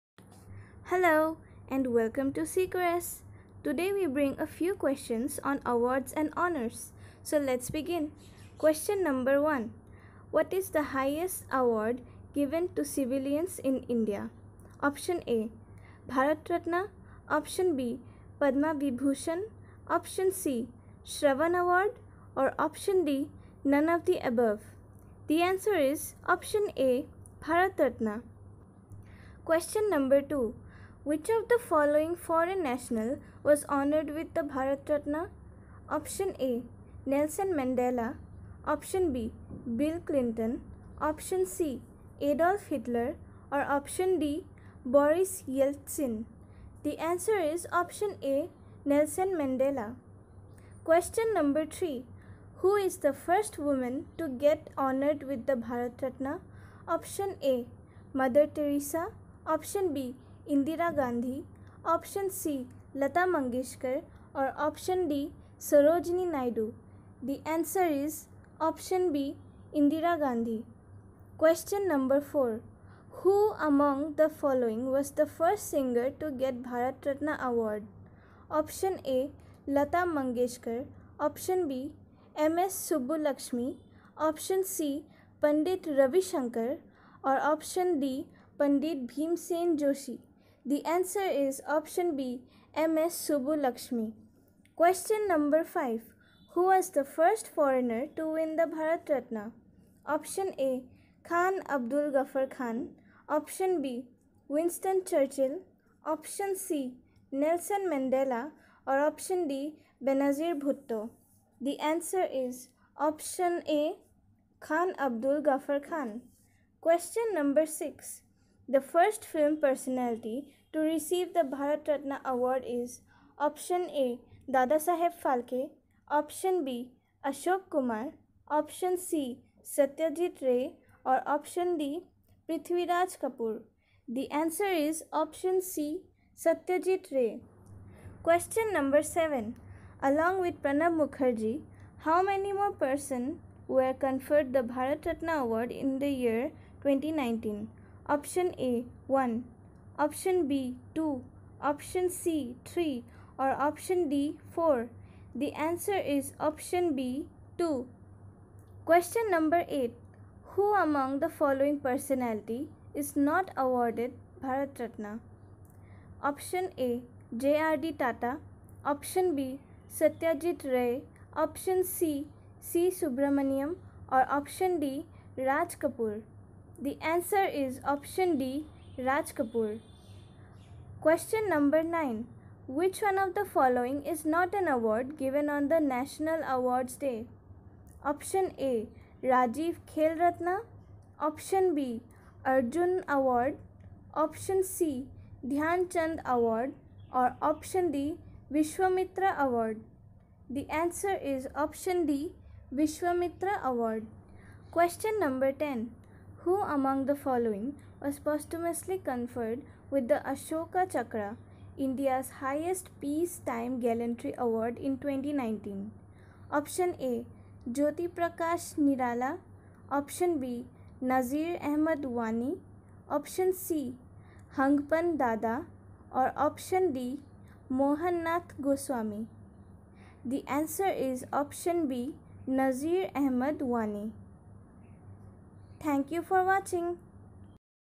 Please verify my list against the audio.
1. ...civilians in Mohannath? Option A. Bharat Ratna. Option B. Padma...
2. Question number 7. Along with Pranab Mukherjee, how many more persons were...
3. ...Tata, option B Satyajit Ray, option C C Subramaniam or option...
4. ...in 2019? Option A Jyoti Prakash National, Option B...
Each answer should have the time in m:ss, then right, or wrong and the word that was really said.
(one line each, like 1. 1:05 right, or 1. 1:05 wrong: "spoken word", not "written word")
1. 0:12 wrong: "India", not "Mohannath"
2. 2:18 right
3. 2:48 right
4. 3:34 wrong: "Nirala", not "National".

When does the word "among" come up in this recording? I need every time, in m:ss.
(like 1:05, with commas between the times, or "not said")
2:40, 3:26.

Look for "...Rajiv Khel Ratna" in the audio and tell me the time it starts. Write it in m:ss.
3:09.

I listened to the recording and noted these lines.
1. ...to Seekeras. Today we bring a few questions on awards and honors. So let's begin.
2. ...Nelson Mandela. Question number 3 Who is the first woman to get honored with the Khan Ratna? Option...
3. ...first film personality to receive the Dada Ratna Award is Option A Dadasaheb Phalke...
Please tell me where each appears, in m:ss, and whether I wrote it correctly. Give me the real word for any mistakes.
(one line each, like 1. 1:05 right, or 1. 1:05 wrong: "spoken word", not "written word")
1. 0:02 right
2. 0:48 wrong: "Bharat", not "Khan"
3. 1:58 wrong: "Bharat", not "Dada".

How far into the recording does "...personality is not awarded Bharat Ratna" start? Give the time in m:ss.
2:41.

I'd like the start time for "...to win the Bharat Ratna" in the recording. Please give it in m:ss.
1:38.